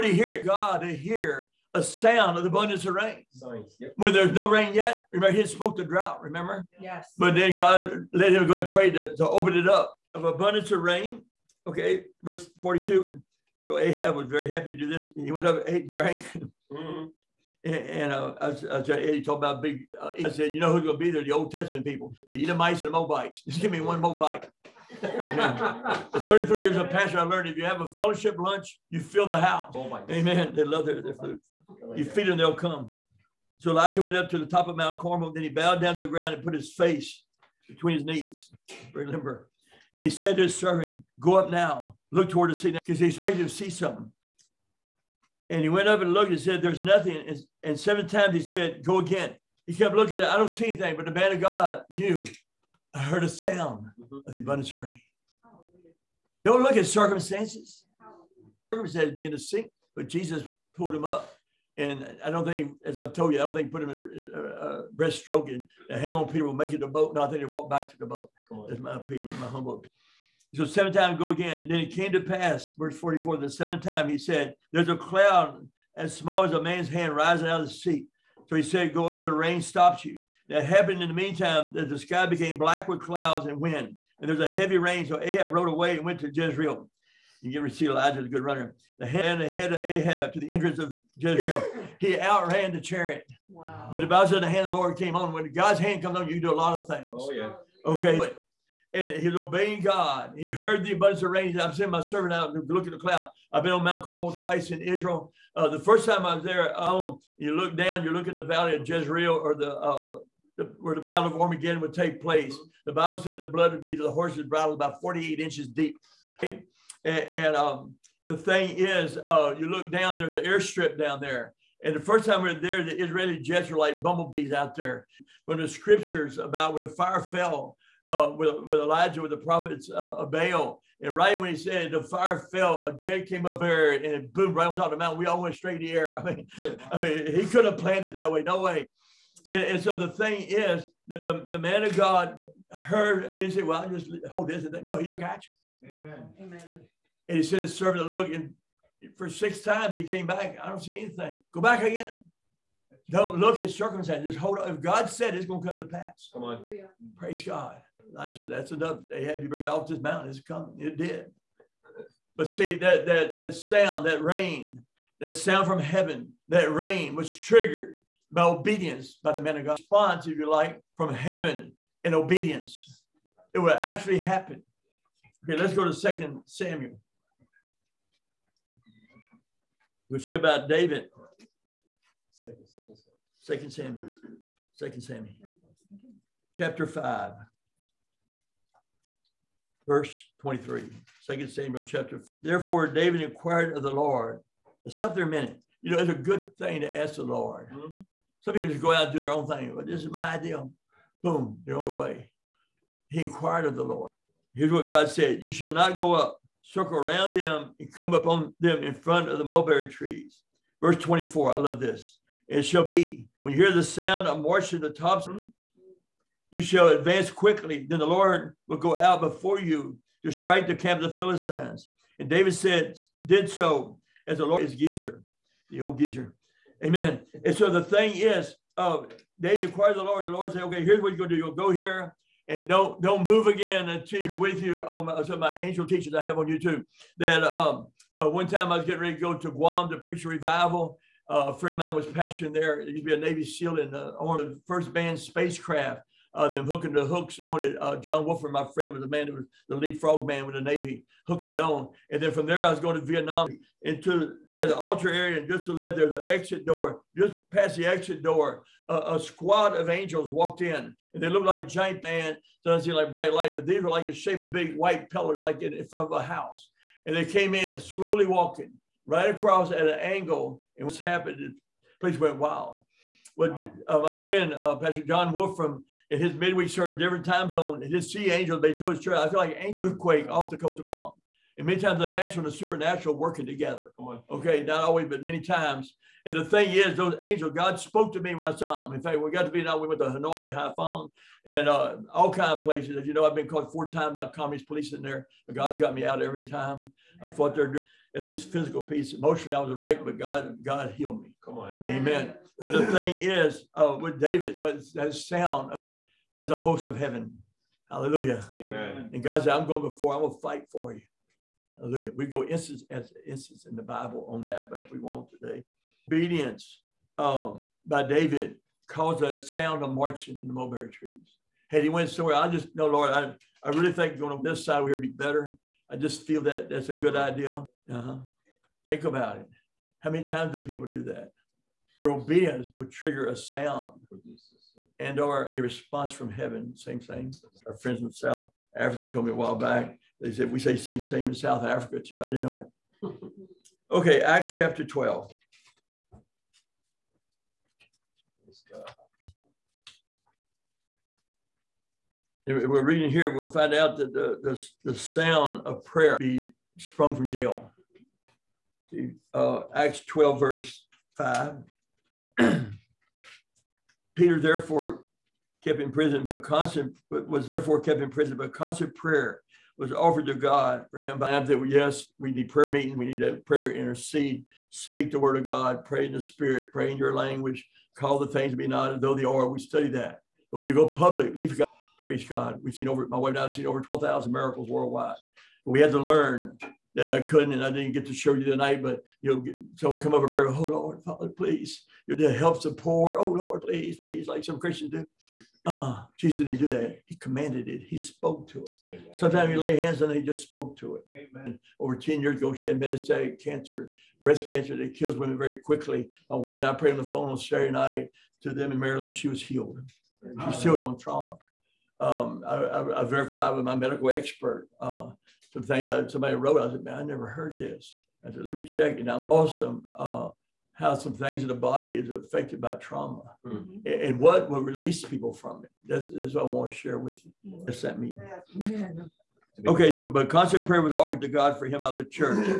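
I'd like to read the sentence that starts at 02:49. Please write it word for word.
Response, if you like, from heaven in obedience.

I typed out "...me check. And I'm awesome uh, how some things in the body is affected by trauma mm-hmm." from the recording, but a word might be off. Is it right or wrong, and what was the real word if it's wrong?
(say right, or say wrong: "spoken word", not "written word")
right.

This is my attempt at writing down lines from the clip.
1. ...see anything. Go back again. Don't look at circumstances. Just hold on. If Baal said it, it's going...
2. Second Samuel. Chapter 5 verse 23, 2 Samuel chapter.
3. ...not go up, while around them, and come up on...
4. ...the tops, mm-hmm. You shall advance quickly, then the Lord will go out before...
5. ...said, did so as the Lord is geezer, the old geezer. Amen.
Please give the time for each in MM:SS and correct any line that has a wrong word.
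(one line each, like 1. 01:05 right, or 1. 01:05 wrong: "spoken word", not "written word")
1. 02:30 wrong: "God", not "Baal"
2. 03:04 right
3. 03:25 wrong: "circle", not "while"
4. 03:34 right
5. 03:42 right.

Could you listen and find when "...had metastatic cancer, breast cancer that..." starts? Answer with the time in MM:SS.
06:42.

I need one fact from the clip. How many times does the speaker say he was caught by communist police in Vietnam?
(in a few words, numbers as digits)
4.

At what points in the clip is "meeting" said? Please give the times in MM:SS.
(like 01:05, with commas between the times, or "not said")
06:12, 07:07.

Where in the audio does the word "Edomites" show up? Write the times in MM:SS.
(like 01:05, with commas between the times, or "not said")
00:22.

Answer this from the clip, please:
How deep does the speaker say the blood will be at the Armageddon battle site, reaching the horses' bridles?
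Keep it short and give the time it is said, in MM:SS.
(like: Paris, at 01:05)
48 inches, at 01:55.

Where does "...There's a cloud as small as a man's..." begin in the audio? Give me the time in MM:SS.
01:14.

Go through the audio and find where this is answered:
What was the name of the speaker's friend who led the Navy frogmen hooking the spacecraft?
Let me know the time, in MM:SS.
04:07.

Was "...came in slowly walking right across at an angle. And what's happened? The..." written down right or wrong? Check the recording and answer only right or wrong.
right.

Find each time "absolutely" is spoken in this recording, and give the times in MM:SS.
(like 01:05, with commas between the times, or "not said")
not said.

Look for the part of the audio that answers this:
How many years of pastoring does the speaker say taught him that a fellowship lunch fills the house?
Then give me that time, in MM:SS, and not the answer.
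00:26.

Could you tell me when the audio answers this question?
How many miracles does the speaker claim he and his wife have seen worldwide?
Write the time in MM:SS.
06:23.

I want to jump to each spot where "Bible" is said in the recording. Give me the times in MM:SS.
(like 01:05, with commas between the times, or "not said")
01:34, 01:52, 05:13.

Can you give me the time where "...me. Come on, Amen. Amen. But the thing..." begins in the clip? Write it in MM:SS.
05:01.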